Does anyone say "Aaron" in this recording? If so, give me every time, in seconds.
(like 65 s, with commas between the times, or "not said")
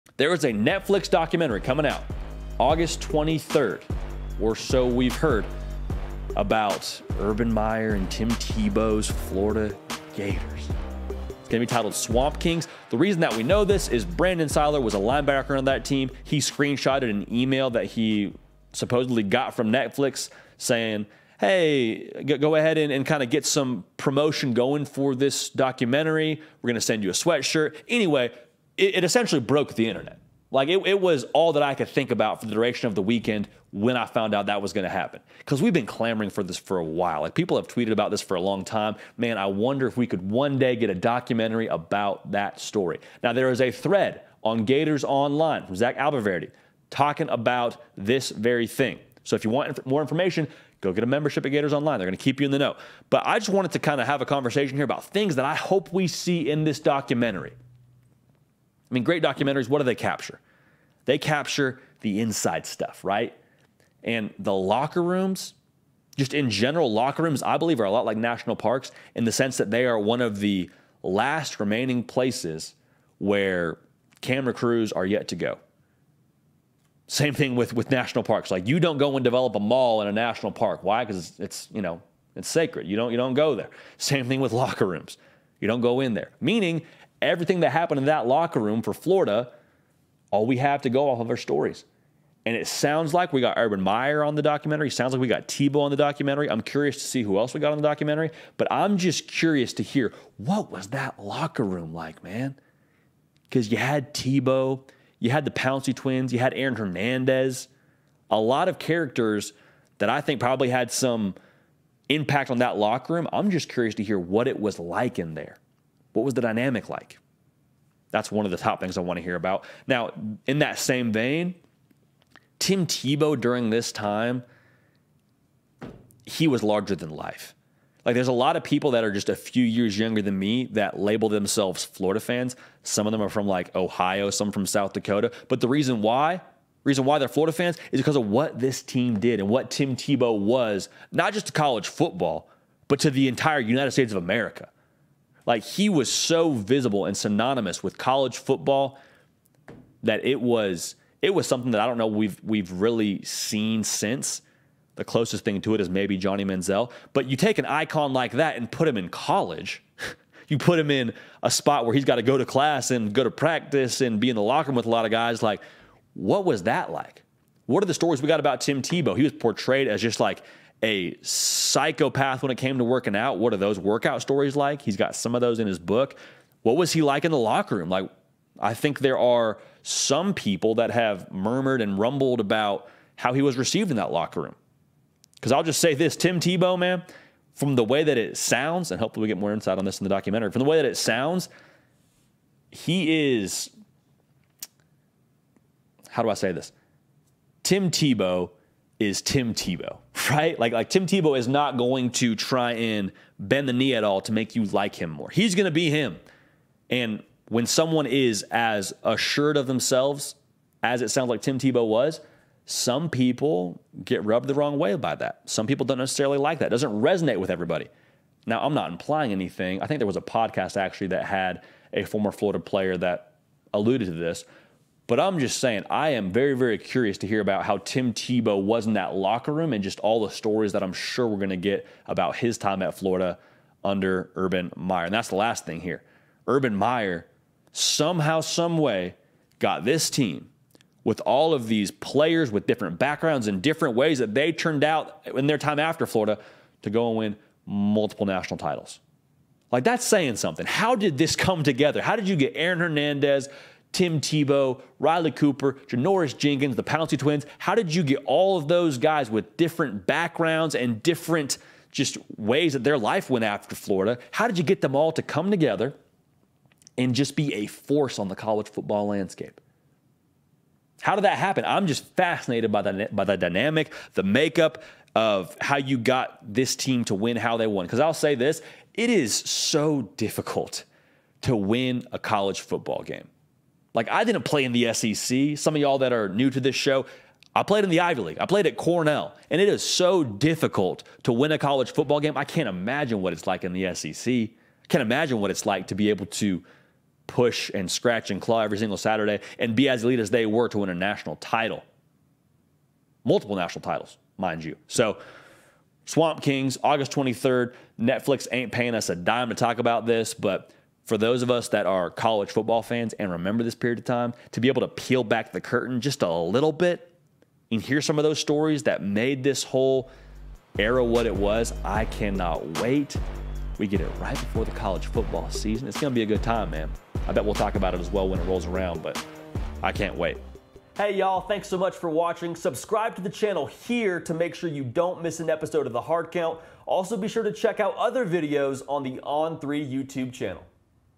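106 s, 252 s.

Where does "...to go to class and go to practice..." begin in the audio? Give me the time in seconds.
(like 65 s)
162 s.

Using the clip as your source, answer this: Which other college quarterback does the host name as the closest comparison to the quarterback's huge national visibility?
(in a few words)
Johnny Manziel.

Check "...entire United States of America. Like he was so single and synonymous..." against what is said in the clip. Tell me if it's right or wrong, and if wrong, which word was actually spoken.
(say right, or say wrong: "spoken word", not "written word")
wrong: "visible", not "single".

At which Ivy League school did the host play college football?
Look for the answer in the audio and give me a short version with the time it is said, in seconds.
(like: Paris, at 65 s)
Cornell, at 288 s.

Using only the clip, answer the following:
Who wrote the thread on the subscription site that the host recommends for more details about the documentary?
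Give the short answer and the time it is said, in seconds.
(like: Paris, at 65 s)
Zach Abolverdi, at 45 s.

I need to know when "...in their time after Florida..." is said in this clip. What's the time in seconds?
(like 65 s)
245 s.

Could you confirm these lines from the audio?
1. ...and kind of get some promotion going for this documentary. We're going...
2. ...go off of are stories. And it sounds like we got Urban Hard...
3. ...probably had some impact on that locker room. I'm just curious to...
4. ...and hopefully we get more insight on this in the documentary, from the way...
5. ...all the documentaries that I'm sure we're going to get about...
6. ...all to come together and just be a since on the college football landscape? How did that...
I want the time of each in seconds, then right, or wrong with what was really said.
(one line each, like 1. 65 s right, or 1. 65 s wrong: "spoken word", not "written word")
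1. 22 s right
2. 90 s wrong: "Meyer", not "Hard"
3. 110 s right
4. 188 s right
5. 229 s wrong: "stories", not "documentaries"
6. 264 s wrong: "force", not "since".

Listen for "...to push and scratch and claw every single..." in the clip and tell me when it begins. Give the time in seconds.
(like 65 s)
296 s.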